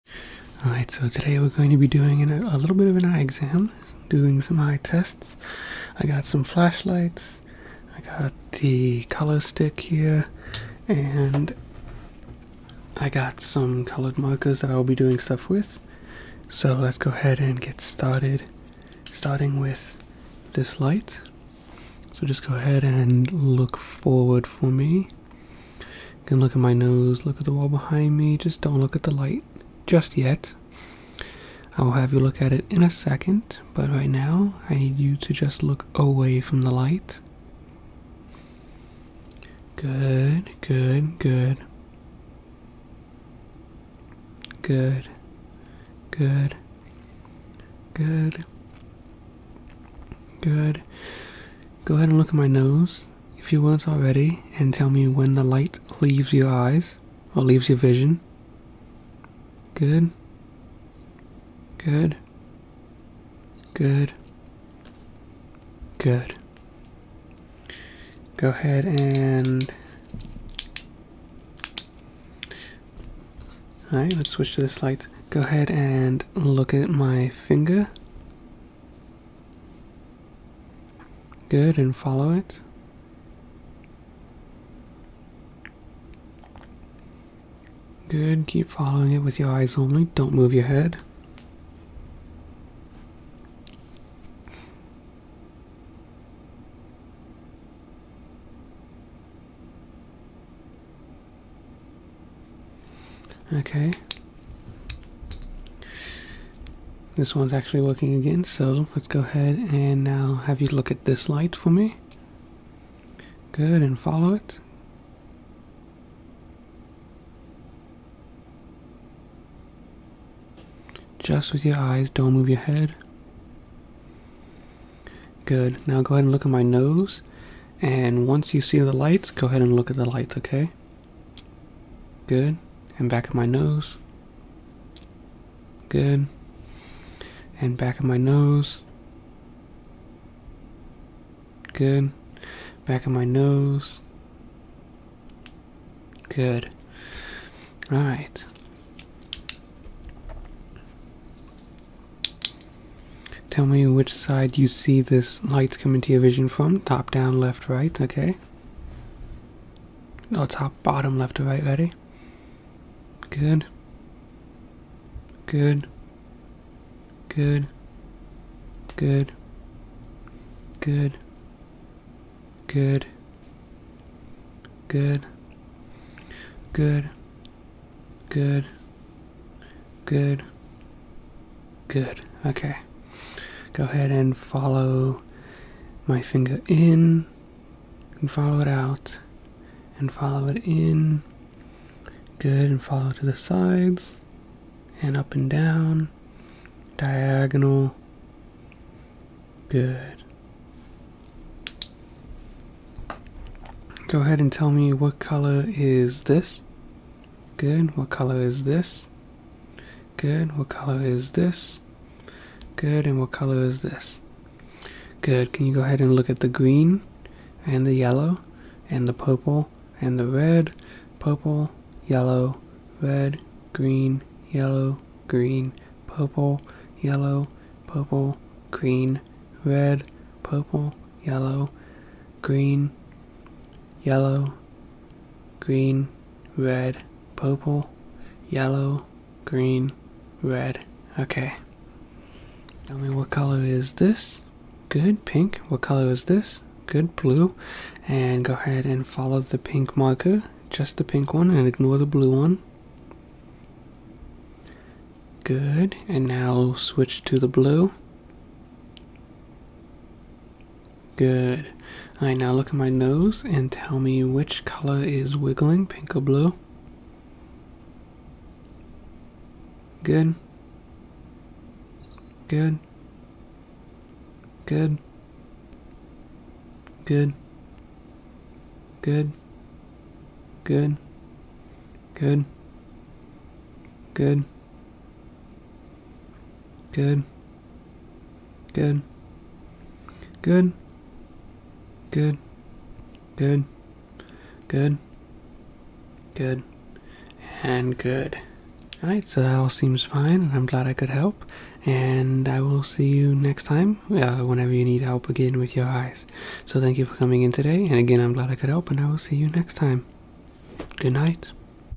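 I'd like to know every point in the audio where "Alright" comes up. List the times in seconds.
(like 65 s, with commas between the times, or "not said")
0 s, 73 s, 147 s, 262 s, 299 s.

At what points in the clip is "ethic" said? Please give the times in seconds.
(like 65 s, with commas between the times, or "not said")
not said.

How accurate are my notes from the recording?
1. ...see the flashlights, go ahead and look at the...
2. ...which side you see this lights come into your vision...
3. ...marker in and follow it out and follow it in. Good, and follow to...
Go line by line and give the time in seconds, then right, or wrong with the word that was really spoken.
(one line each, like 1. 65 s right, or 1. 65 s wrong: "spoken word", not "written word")
1. 128 s wrong: "lights", not "flashlights"
2. 153 s right
3. 186 s wrong: "finger", not "marker".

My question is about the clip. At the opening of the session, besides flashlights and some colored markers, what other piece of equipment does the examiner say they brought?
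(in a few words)
color stick.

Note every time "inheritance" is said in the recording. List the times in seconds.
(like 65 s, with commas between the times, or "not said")
not said.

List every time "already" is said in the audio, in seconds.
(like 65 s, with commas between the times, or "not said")
53 s.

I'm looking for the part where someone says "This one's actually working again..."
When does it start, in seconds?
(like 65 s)
107 s.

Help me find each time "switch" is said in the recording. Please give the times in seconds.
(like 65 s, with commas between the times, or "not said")
74 s, 256 s.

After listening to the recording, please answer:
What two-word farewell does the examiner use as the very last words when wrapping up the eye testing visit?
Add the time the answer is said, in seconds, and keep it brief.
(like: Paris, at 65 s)
Good night, at 310 s.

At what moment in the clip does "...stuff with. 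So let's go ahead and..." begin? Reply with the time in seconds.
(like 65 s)
15 s.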